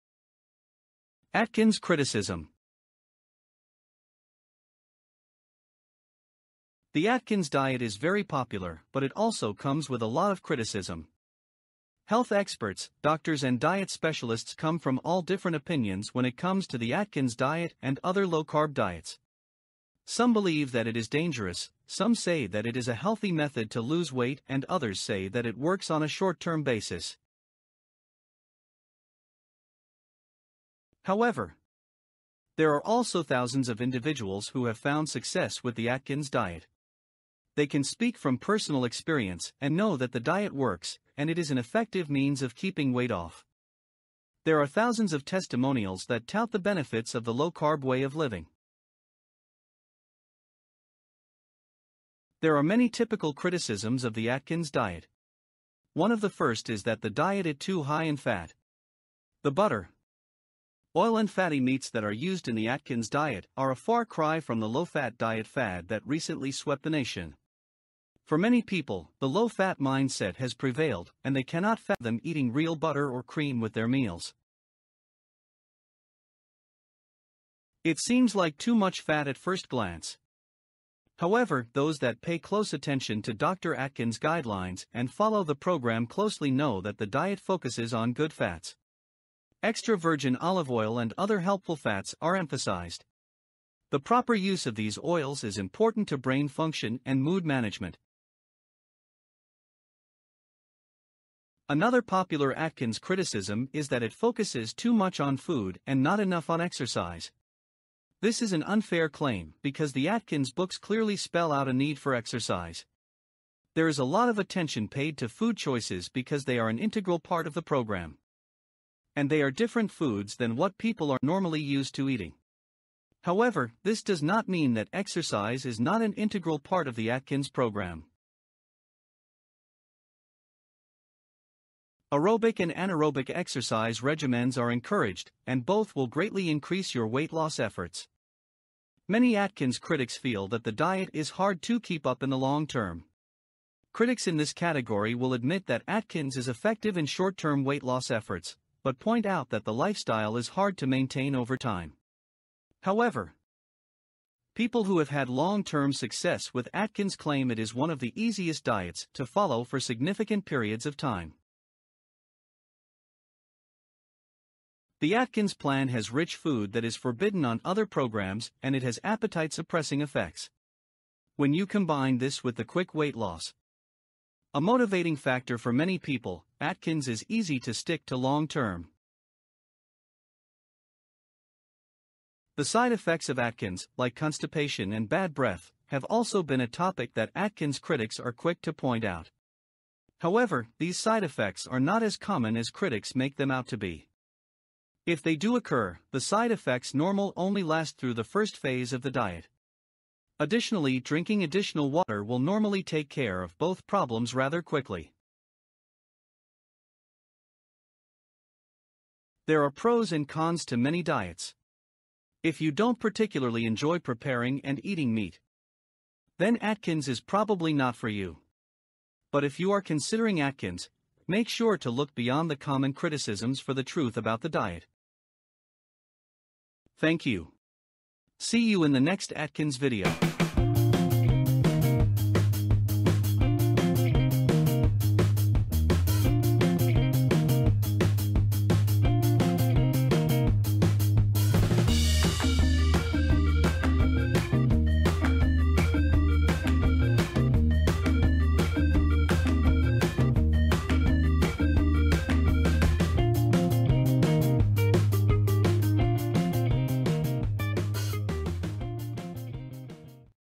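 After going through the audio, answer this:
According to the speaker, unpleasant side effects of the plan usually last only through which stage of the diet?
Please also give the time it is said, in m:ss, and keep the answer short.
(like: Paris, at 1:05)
the first phase, at 3:18.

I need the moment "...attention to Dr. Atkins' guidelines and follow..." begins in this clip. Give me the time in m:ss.
1:22.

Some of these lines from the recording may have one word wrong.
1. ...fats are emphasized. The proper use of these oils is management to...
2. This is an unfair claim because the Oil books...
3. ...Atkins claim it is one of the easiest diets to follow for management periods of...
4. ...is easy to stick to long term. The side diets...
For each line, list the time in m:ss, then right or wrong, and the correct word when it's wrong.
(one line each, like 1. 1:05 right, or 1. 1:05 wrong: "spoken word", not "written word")
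1. 1:31 wrong: "important", not "management"
2. 1:48 wrong: "Atkins", not "Oil"
3. 2:36 wrong: "significant", not "management"
4. 2:57 wrong: "effects", not "diets".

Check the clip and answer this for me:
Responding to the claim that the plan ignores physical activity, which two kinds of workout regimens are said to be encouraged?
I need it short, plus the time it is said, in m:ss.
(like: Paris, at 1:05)
aerobic and anaerobic, at 2:12.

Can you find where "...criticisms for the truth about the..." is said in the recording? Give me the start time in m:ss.
3:42.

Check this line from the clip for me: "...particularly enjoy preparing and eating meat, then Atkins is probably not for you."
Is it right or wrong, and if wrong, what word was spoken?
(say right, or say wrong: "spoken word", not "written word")
right.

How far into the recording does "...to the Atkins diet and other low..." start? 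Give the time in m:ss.
0:16.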